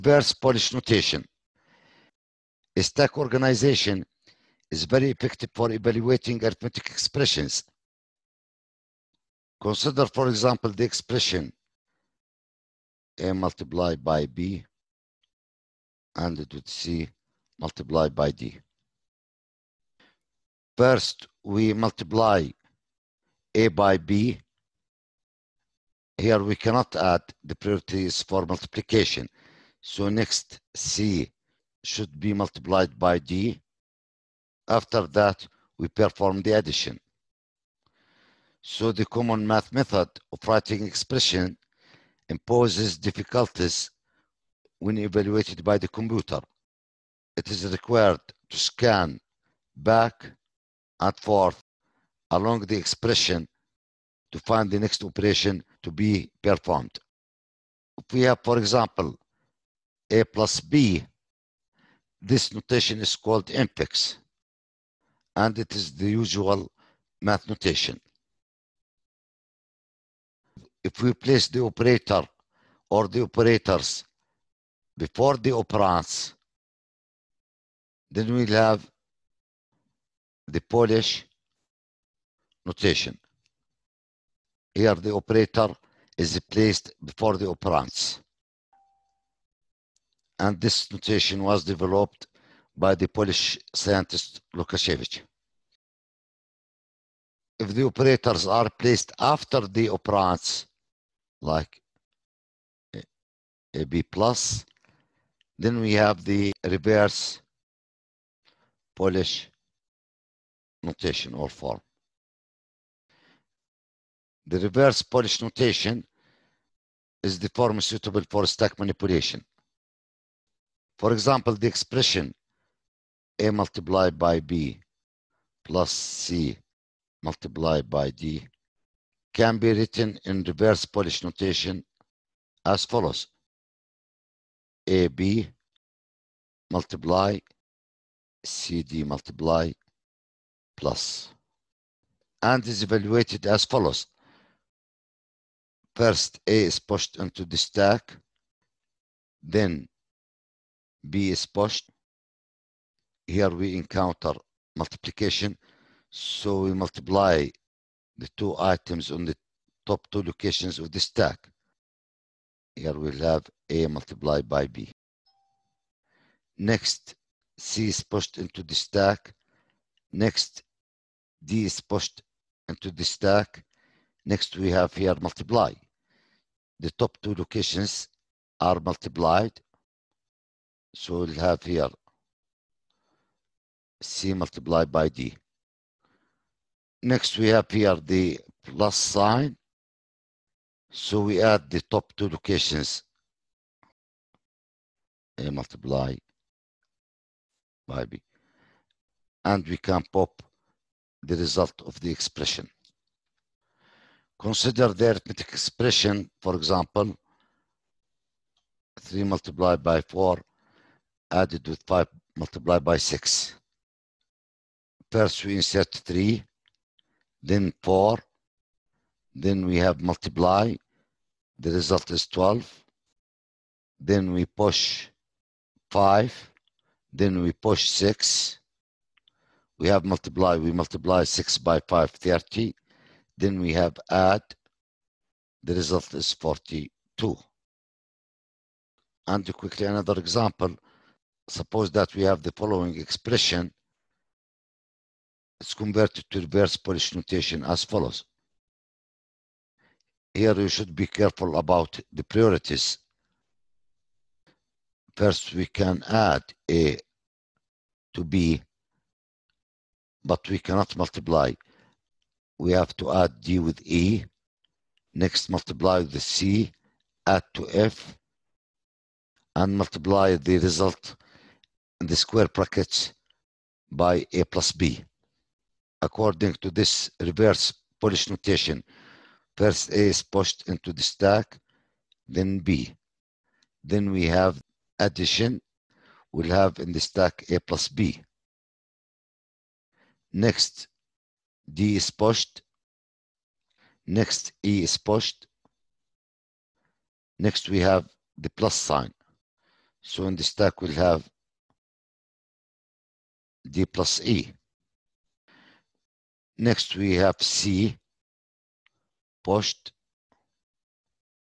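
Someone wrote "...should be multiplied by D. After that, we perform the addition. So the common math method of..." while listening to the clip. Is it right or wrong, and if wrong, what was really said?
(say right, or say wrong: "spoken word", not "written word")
right.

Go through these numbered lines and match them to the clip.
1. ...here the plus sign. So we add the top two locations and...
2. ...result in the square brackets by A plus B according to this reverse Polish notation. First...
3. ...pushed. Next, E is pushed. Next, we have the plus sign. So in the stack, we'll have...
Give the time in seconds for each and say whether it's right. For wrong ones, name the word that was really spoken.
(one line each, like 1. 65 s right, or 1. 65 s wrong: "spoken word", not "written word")
1. 187 s right
2. 270 s right
3. 292 s right.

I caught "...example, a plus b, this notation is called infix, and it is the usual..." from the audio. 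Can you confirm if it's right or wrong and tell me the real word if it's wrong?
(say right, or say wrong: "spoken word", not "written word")
right.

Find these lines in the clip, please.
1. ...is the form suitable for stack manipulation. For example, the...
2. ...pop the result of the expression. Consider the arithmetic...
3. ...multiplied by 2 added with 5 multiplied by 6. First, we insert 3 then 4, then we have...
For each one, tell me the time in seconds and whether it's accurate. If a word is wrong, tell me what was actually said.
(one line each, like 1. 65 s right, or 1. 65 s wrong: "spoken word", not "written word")
1. 117 s right
2. 200 s right
3. 209 s wrong: "4", not "2".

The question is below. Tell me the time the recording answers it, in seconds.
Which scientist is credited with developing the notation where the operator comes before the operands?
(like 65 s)
94 s.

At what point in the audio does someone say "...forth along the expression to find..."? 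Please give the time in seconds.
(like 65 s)
51 s.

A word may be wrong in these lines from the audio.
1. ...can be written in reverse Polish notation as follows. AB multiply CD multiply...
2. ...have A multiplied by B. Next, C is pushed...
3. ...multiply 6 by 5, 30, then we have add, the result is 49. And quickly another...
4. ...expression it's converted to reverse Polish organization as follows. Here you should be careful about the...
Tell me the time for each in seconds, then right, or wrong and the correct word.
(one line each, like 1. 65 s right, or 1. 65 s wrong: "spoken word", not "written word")
1. 129 s right
2. 163 s right
3. 230 s wrong: "42", not "49"
4. 242 s wrong: "notation", not "organization".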